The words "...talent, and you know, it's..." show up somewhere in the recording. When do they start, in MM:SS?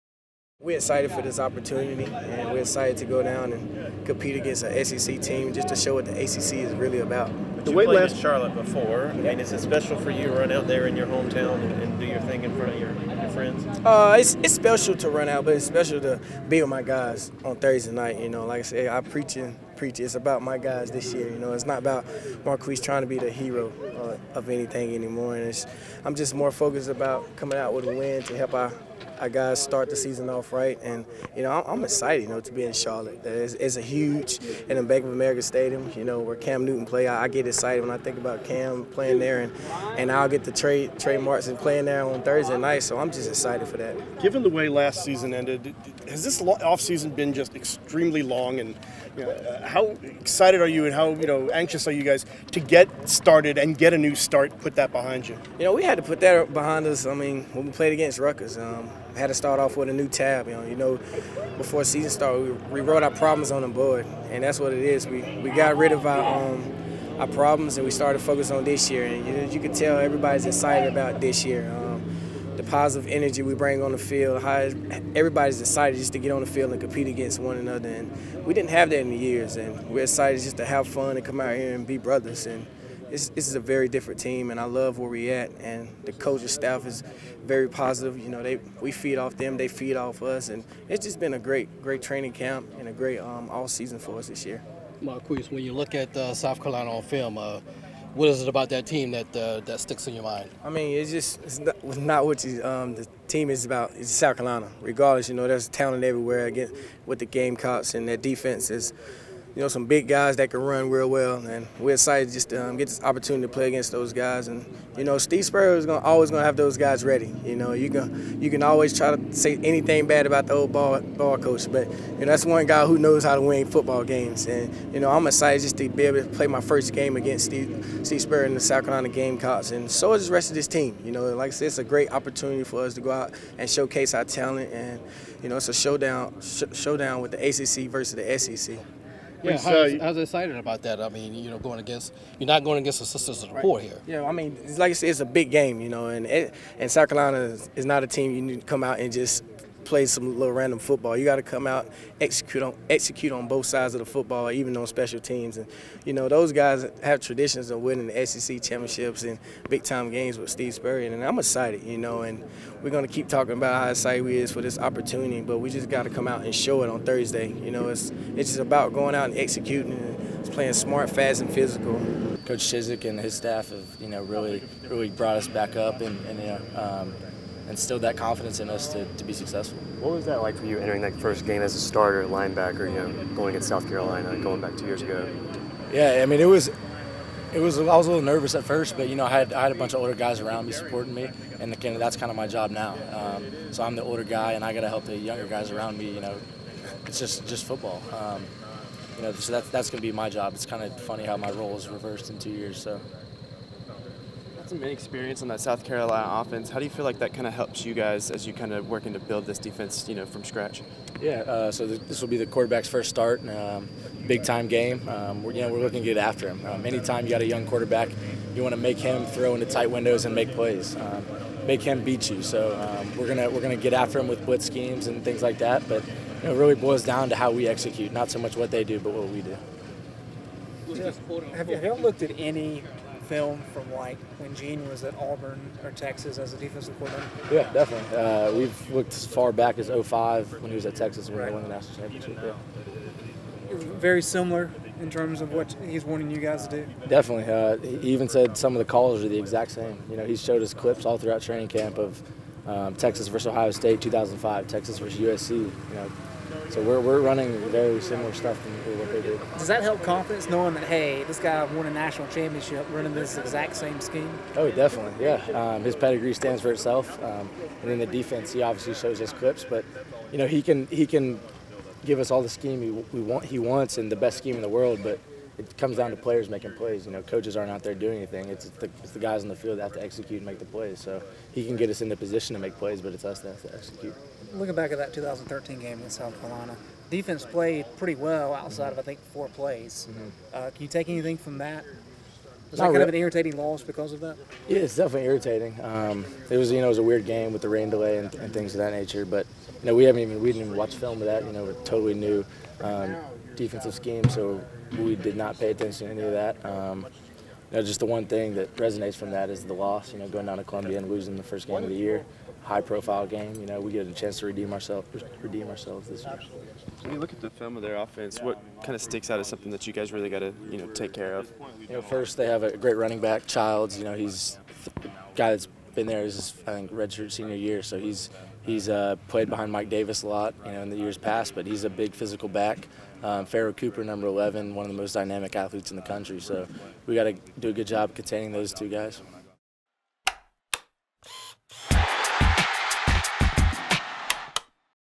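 02:14.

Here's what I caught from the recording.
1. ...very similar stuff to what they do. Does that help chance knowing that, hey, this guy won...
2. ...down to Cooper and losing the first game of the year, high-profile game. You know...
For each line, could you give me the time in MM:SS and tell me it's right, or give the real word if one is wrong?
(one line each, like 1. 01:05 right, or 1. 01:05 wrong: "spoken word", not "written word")
1. 04:17 wrong: "confidence", not "chance"
2. 05:10 wrong: "Columbia", not "Cooper".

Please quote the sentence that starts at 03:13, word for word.
Um, so I'm the older guy, and I got to help the younger guys around me.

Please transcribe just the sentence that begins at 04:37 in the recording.
You know, coaches aren't out there doing anything.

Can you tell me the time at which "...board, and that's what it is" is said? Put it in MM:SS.
01:03.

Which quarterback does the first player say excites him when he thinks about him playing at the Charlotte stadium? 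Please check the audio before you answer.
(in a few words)
Cam Newton.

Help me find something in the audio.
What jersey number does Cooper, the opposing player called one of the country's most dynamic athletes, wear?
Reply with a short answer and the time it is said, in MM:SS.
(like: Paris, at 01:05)
11, at 05:34.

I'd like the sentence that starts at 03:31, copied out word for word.
Yeah, uh, so this will be the quarterback's first start, um, big time game.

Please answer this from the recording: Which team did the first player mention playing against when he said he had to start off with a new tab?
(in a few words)
Rutgers.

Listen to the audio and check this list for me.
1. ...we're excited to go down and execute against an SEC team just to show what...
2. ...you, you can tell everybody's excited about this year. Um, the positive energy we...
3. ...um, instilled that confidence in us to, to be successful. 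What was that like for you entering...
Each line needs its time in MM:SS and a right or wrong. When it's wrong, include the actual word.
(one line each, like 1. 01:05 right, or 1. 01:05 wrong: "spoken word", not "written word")
1. 00:02 wrong: "compete", not "execute"
2. 01:09 right
3. 02:56 right.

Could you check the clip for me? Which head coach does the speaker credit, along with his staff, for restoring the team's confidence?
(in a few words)
Coach Chizik.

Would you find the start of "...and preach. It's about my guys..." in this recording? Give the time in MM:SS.
00:19.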